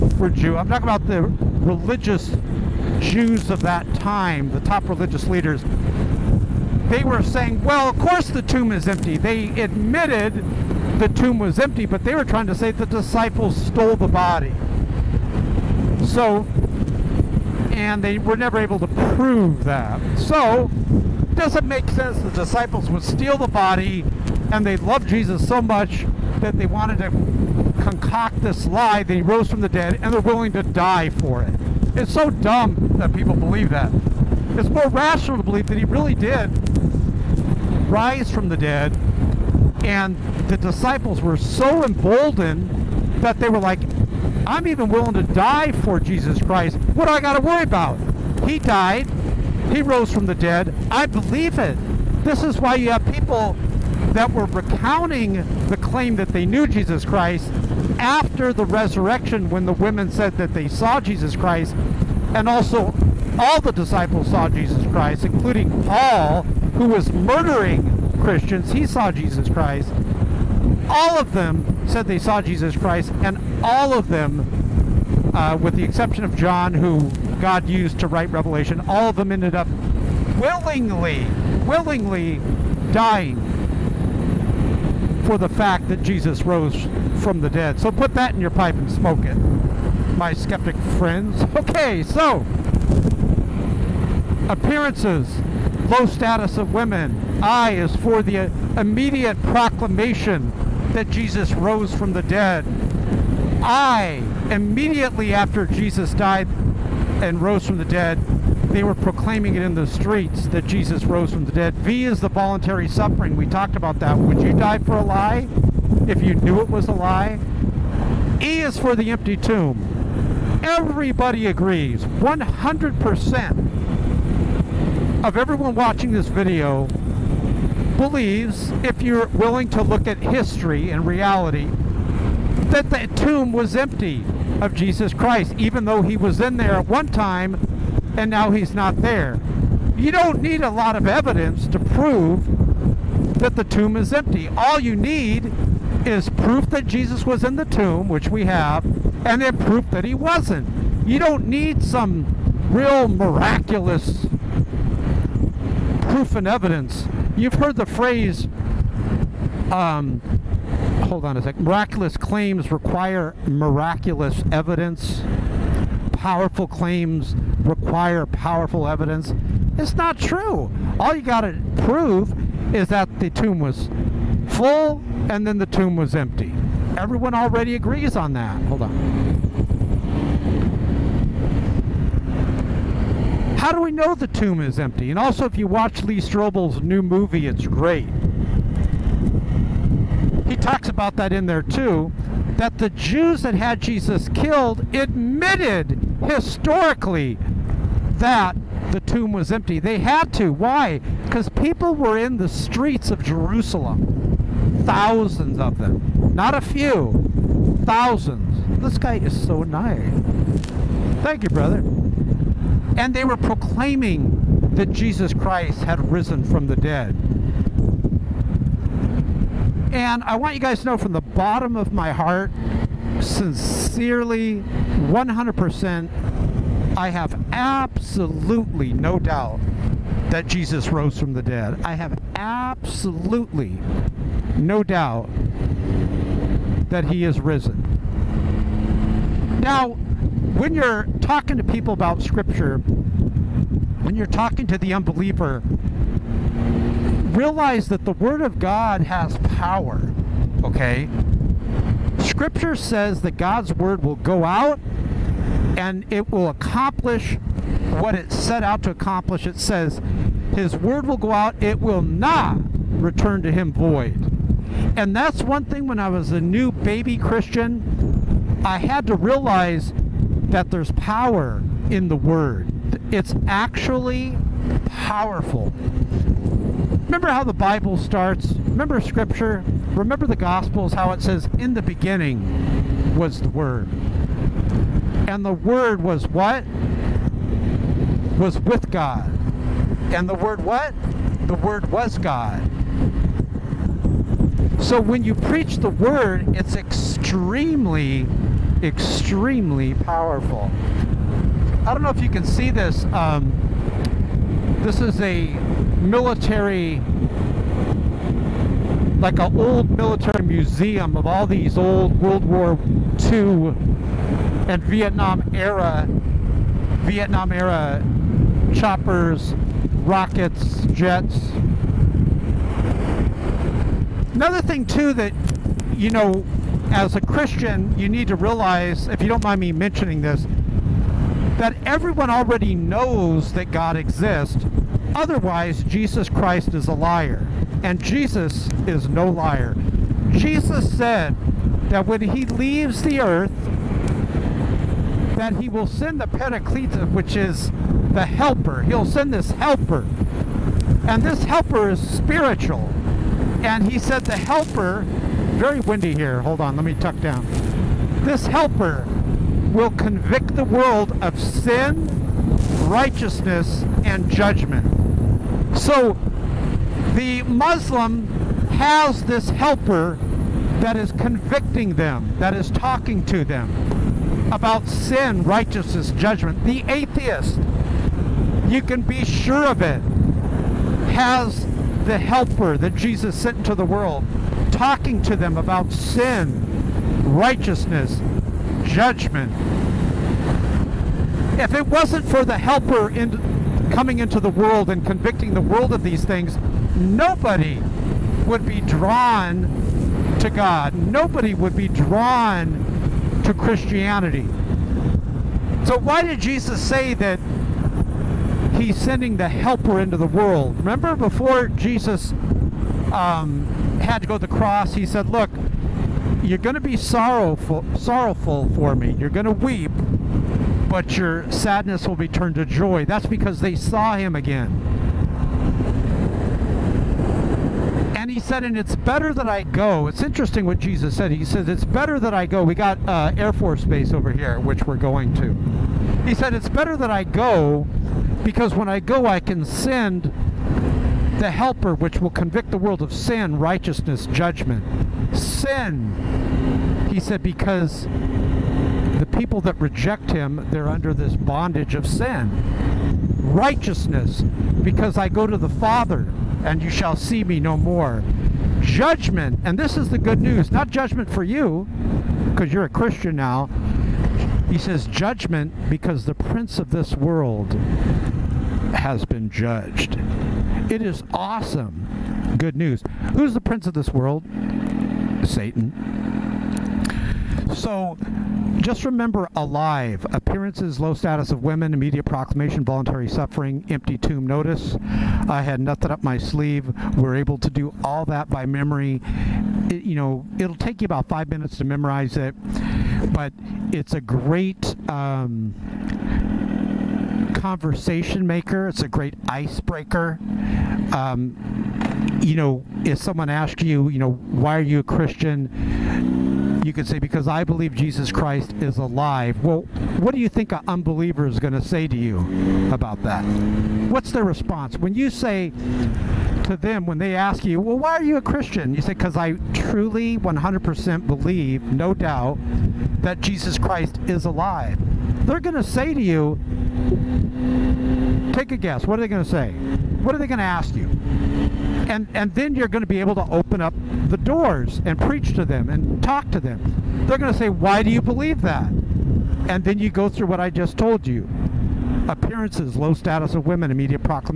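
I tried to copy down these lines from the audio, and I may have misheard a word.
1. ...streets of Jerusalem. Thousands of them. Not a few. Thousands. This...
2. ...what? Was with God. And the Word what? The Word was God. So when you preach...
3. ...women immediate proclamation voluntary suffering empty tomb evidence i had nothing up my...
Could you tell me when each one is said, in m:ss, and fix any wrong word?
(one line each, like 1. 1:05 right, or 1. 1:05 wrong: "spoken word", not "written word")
1. 3:22 right
2. 4:46 right
3. 8:01 wrong: "notice", not "evidence".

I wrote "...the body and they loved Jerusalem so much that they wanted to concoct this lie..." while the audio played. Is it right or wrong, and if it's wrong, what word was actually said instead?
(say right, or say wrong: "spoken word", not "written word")
wrong: "Jesus", not "Jerusalem".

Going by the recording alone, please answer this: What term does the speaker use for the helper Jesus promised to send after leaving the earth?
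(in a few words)
Paraclete.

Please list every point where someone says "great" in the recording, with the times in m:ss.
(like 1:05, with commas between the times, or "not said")
3:07, 8:14, 8:19.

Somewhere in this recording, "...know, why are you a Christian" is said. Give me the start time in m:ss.
8:24.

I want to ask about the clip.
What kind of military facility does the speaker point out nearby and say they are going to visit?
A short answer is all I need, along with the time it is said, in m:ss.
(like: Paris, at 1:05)
Air Force Base, at 7:13.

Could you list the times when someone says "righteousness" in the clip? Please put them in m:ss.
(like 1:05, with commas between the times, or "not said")
6:02, 6:15, 6:27, 7:23, 7:33.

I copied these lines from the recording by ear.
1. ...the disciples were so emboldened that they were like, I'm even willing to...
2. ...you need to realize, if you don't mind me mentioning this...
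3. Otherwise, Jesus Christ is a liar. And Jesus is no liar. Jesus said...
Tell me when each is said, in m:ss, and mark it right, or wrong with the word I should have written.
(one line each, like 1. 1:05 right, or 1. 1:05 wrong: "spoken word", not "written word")
1. 0:40 right
2. 5:27 right
3. 5:35 right.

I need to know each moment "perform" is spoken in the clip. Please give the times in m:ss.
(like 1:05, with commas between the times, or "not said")
not said.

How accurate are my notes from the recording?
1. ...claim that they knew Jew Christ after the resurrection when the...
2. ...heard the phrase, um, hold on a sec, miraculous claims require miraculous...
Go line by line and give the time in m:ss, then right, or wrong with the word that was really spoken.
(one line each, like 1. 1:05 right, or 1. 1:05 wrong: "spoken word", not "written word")
1. 0:55 wrong: "Jesus", not "Jew"
2. 2:37 right.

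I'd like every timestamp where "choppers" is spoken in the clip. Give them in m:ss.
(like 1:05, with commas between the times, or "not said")
5:18.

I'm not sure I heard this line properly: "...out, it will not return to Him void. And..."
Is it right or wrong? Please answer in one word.
right.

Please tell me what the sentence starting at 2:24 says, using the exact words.
All you need is proof that Jesus was in the tomb, which we have, and then proof that he wasn't.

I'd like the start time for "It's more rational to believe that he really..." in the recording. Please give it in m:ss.
0:34.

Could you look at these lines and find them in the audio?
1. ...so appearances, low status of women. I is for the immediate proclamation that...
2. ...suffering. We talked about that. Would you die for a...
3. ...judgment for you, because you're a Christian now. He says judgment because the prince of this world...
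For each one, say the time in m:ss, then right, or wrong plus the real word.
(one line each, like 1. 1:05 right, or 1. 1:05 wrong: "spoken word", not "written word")
1. 1:32 right
2. 1:52 right
3. 7:40 right.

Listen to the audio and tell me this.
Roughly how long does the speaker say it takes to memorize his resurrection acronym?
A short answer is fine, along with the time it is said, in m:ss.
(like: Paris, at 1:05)
5 minutes, at 8:11.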